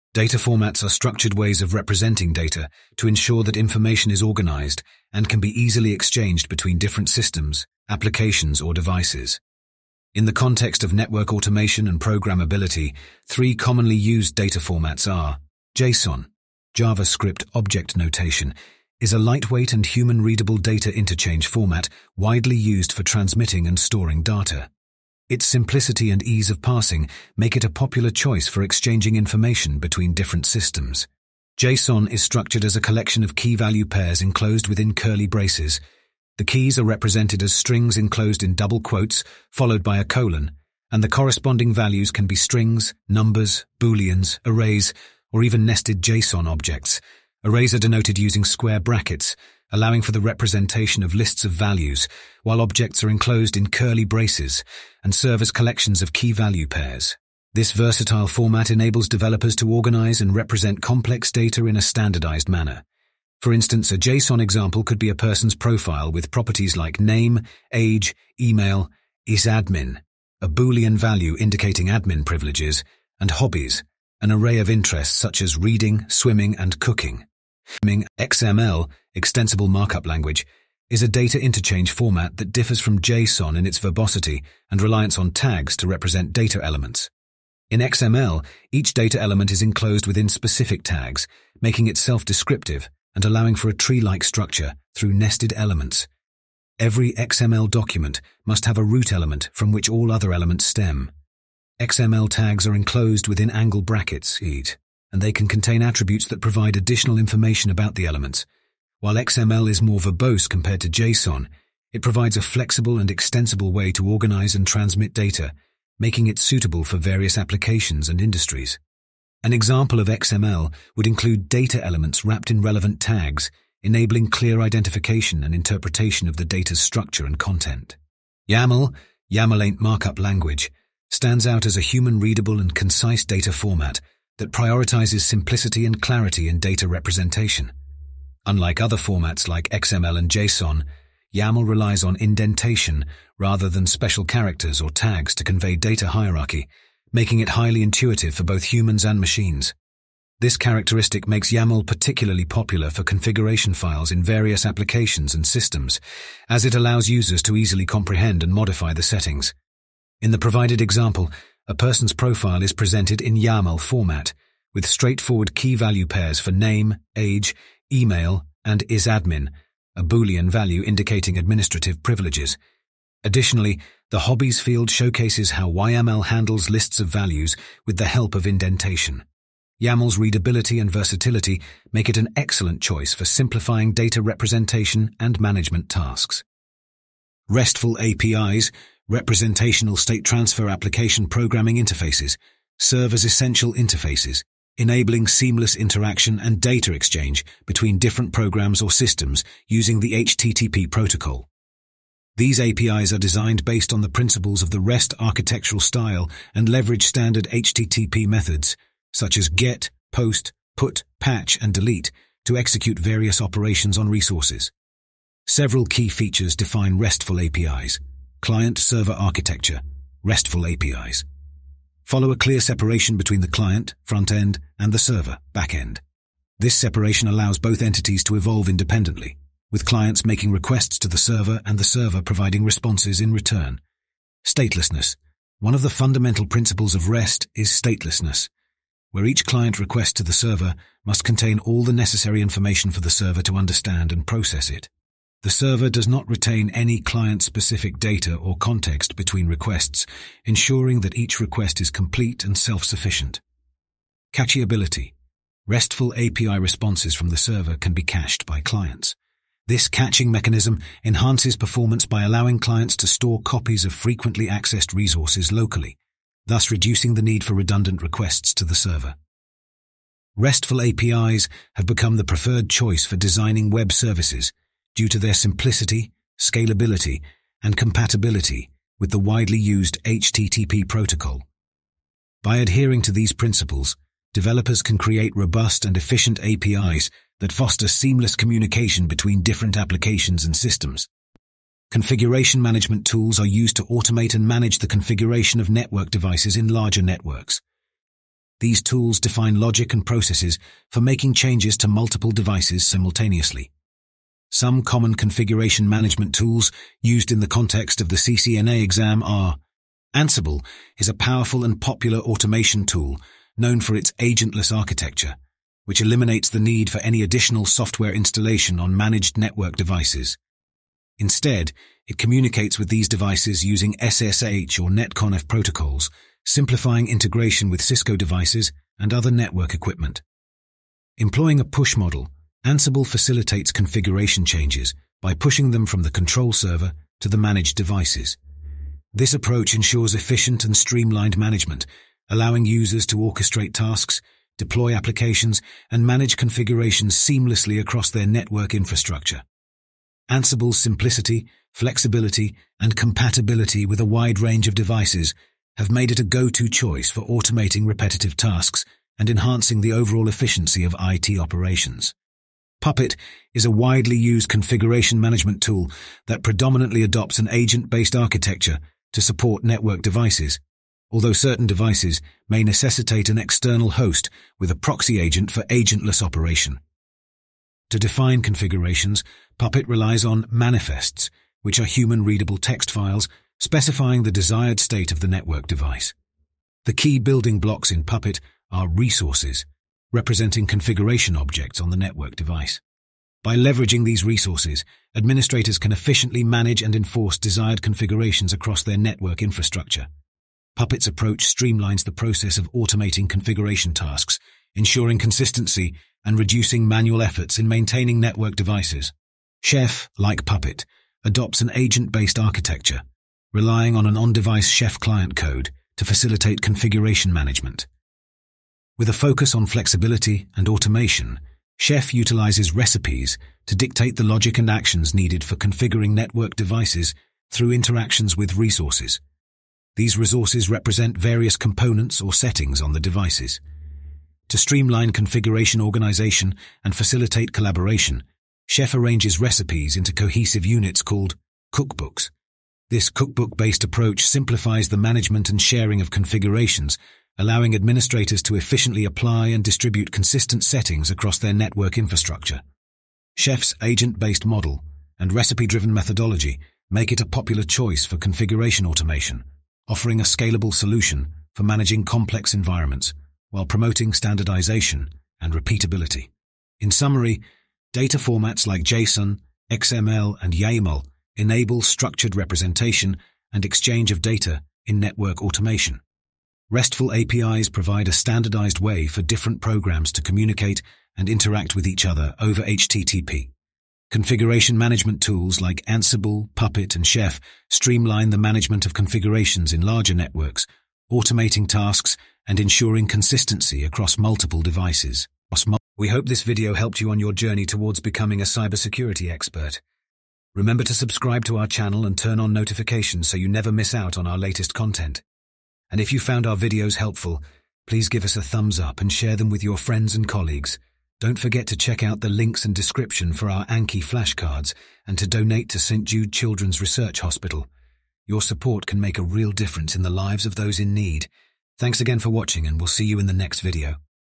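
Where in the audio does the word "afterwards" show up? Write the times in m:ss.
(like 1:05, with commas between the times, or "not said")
not said.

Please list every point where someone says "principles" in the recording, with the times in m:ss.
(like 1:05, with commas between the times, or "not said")
3:24, 3:56, 4:43.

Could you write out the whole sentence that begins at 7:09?
These resources represent various components or settings on the devices.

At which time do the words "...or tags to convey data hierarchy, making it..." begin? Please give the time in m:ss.
2:24.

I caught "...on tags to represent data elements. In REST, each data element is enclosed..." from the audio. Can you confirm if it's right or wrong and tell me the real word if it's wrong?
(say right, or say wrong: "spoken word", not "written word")
wrong: "XML", not "REST".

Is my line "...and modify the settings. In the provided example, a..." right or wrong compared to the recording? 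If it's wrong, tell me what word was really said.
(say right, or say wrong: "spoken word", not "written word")
right.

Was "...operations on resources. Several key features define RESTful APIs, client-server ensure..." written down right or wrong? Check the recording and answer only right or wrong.
wrong.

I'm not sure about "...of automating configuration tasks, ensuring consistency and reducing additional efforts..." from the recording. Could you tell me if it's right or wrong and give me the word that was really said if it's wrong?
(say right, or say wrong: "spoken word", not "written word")
wrong: "manual", not "additional".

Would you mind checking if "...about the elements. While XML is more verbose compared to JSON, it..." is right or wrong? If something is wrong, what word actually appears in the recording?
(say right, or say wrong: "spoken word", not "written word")
right.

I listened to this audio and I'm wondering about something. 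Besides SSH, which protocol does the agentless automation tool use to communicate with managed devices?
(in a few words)
NetConf.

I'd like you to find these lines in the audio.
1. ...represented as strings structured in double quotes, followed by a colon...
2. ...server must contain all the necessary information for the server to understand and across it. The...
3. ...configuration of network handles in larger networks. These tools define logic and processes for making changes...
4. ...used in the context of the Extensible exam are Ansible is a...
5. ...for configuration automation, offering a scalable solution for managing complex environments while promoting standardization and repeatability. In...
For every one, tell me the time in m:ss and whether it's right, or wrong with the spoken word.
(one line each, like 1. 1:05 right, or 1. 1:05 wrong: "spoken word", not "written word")
1. 0:36 wrong: "enclosed", not "structured"
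2. 4:00 wrong: "process", not "across"
3. 4:54 wrong: "devices", not "handles"
4. 5:07 wrong: "CCNA", not "Extensible"
5. 7:38 right.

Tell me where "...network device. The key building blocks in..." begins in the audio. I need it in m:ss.
6:25.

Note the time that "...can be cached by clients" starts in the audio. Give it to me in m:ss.
4:17.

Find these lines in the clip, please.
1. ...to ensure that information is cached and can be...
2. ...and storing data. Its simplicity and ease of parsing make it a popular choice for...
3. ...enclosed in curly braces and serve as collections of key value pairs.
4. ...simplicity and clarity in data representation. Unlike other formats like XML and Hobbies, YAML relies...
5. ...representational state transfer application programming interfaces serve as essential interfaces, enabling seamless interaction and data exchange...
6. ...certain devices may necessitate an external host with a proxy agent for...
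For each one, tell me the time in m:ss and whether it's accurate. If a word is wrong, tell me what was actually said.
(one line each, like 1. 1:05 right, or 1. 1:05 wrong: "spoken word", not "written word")
1. 0:02 wrong: "organized", not "cached"
2. 0:23 right
3. 0:53 right
4. 2:15 wrong: "JSON", not "Hobbies"
5. 3:09 right
6. 6:11 right.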